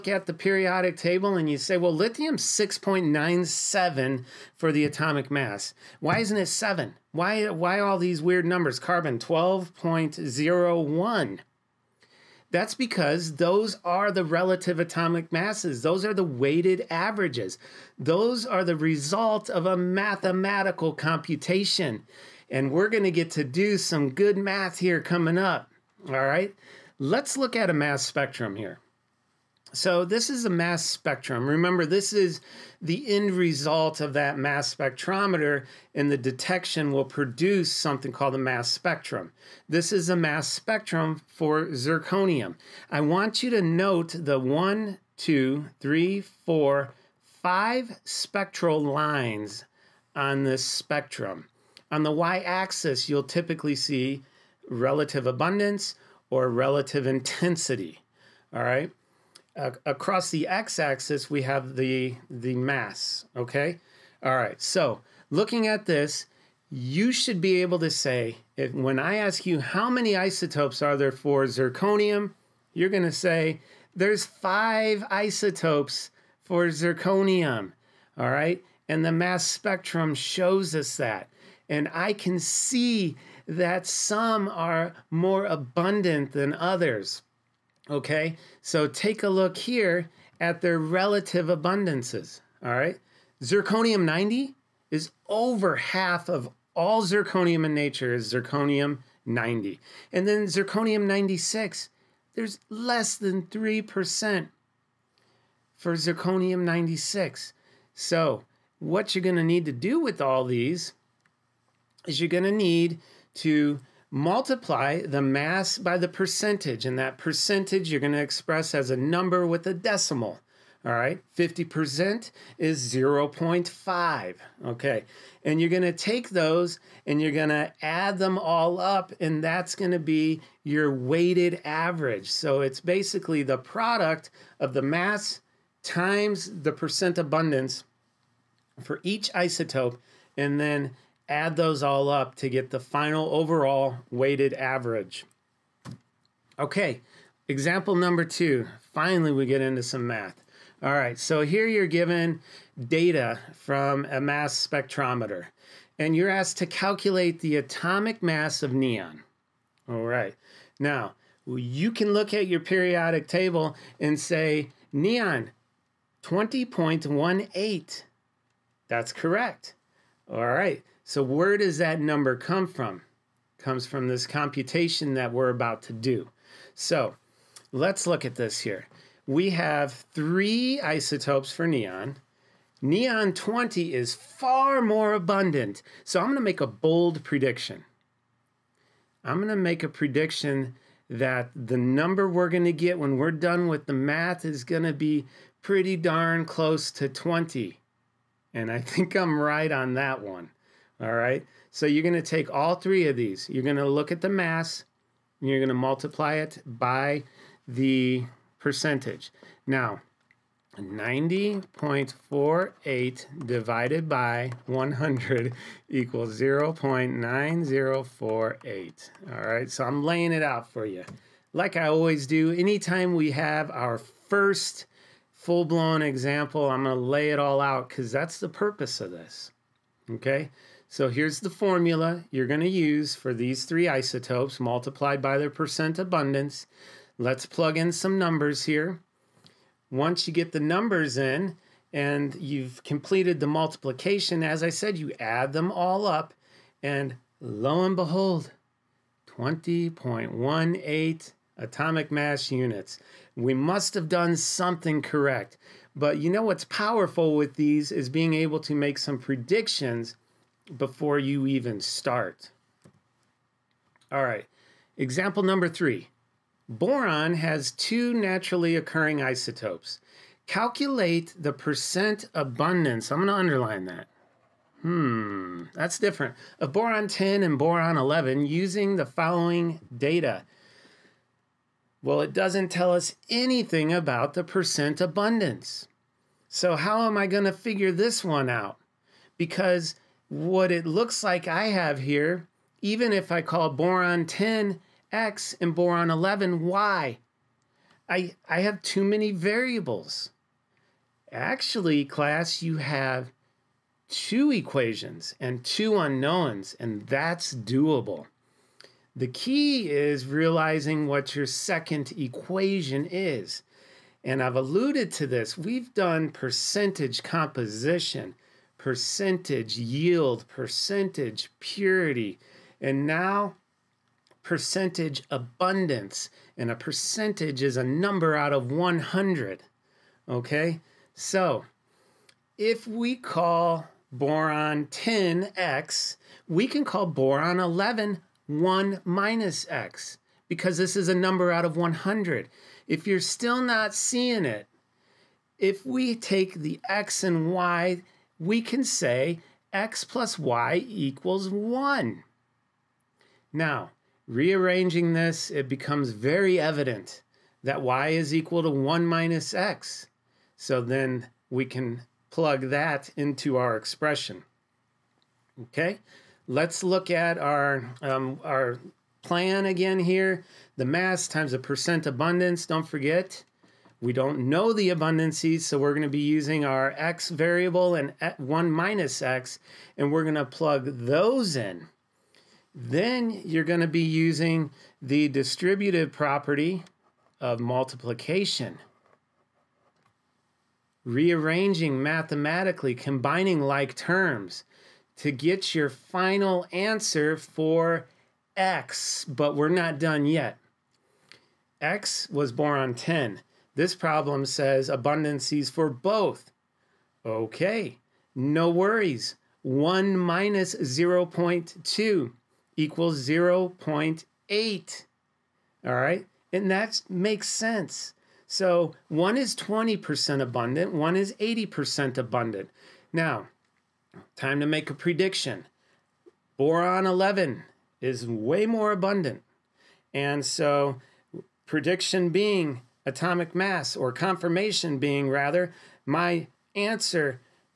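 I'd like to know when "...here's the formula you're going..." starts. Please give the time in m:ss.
3:51.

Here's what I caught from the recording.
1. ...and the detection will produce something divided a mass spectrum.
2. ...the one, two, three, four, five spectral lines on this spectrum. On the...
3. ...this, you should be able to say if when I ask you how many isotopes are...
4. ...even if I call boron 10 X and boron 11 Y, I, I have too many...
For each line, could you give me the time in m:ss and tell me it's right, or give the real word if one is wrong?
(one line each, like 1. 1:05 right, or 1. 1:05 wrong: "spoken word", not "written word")
1. 0:35 wrong: "called", not "divided"
2. 0:44 right
3. 1:05 right
4. 4:52 right.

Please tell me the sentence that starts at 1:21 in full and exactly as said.
And I can see that some are more abundant than others.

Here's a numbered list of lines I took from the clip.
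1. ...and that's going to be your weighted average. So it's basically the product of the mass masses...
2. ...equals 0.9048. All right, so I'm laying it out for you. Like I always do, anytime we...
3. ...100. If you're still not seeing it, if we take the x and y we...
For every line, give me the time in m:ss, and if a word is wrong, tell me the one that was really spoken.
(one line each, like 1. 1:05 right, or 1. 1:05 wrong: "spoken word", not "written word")
1. 2:09 wrong: "times", not "masses"
2. 3:35 right
3. 5:41 right.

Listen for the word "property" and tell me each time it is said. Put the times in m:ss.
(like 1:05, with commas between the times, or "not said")
6:26.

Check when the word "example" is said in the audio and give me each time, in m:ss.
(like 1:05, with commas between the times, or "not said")
2:27, 3:46, 4:24.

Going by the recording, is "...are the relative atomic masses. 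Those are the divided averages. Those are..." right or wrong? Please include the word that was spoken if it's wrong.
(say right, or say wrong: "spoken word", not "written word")
wrong: "weighted", not "divided".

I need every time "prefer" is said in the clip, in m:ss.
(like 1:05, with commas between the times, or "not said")
not said.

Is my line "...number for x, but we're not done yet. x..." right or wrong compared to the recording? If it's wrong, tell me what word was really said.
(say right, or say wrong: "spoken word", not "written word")
wrong: "answer", not "number".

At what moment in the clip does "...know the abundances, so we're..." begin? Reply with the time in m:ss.
6:14.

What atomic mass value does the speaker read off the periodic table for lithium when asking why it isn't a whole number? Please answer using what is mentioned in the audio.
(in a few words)
6.97.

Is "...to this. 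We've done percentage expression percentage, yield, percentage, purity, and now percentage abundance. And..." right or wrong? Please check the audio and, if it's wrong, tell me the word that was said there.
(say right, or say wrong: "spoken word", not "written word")
wrong: "composition", not "expression".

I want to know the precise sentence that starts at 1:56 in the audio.
And that percentage you're going to express as a number with a decimal.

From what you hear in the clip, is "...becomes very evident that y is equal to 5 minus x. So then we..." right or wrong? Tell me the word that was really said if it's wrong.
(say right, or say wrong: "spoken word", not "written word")
wrong: "1", not "5".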